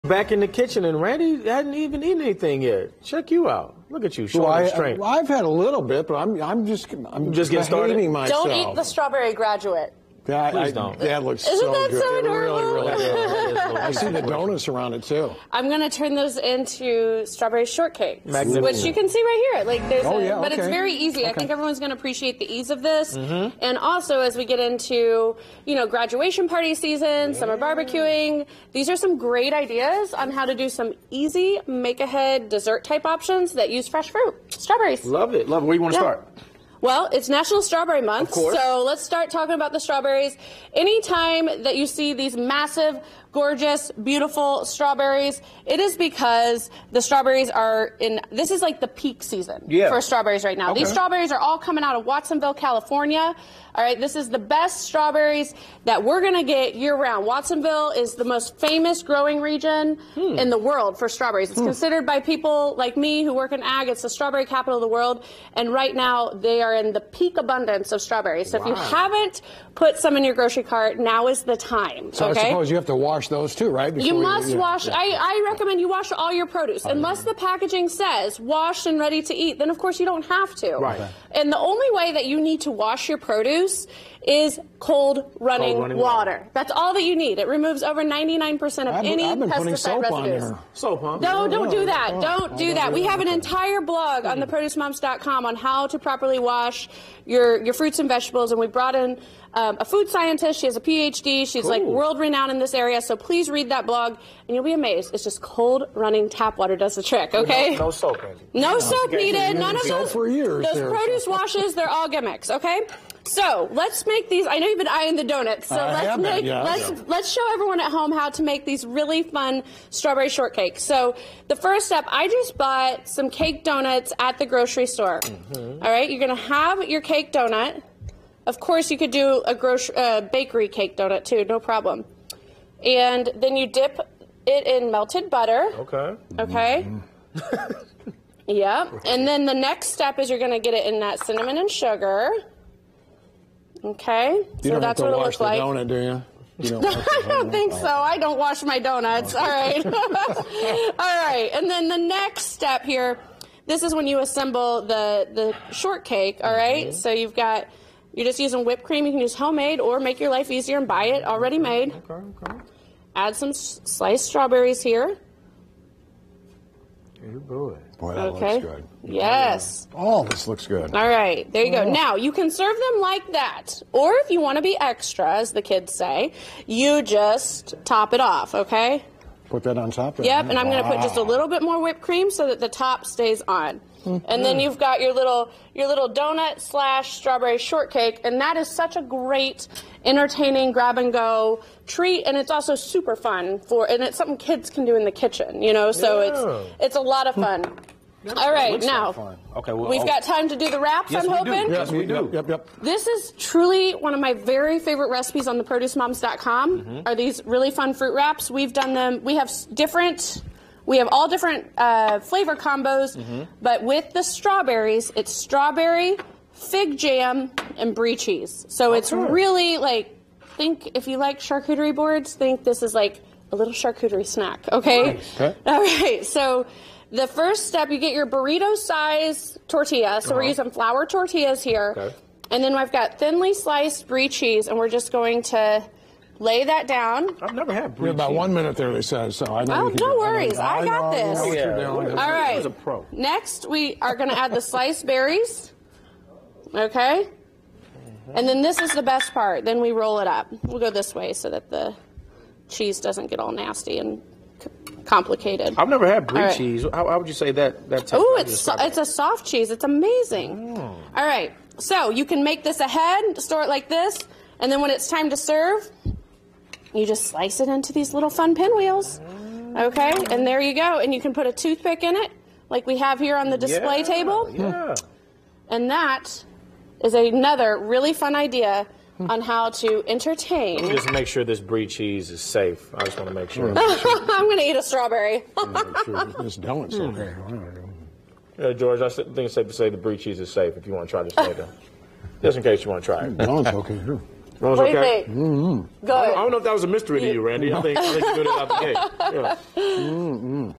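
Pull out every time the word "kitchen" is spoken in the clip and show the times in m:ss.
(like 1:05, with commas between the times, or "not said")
0:00, 3:15.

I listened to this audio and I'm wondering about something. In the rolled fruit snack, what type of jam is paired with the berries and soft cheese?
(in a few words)
fig jam.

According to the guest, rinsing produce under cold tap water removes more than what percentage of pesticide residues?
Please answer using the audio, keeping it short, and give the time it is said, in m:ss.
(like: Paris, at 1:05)
99%, at 1:28.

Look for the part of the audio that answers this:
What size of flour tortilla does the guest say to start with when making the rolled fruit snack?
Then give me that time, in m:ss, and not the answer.
3:48.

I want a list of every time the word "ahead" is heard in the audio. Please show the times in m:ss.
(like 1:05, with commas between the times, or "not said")
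0:31, 4:22.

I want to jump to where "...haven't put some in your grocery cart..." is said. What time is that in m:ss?
1:08.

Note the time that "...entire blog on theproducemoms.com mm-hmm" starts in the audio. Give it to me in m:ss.
1:33.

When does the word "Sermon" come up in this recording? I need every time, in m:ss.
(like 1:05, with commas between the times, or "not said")
not said.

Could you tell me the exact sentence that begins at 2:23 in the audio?
Okay, you so don't that's have to what wash it looks the like.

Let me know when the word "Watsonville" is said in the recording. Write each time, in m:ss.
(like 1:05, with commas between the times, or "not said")
0:52, 0:57.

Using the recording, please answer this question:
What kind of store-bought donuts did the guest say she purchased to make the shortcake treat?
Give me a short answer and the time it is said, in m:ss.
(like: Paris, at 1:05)
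cake donuts, at 2:03.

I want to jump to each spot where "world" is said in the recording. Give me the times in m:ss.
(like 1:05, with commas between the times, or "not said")
1:00, 1:04, 1:41.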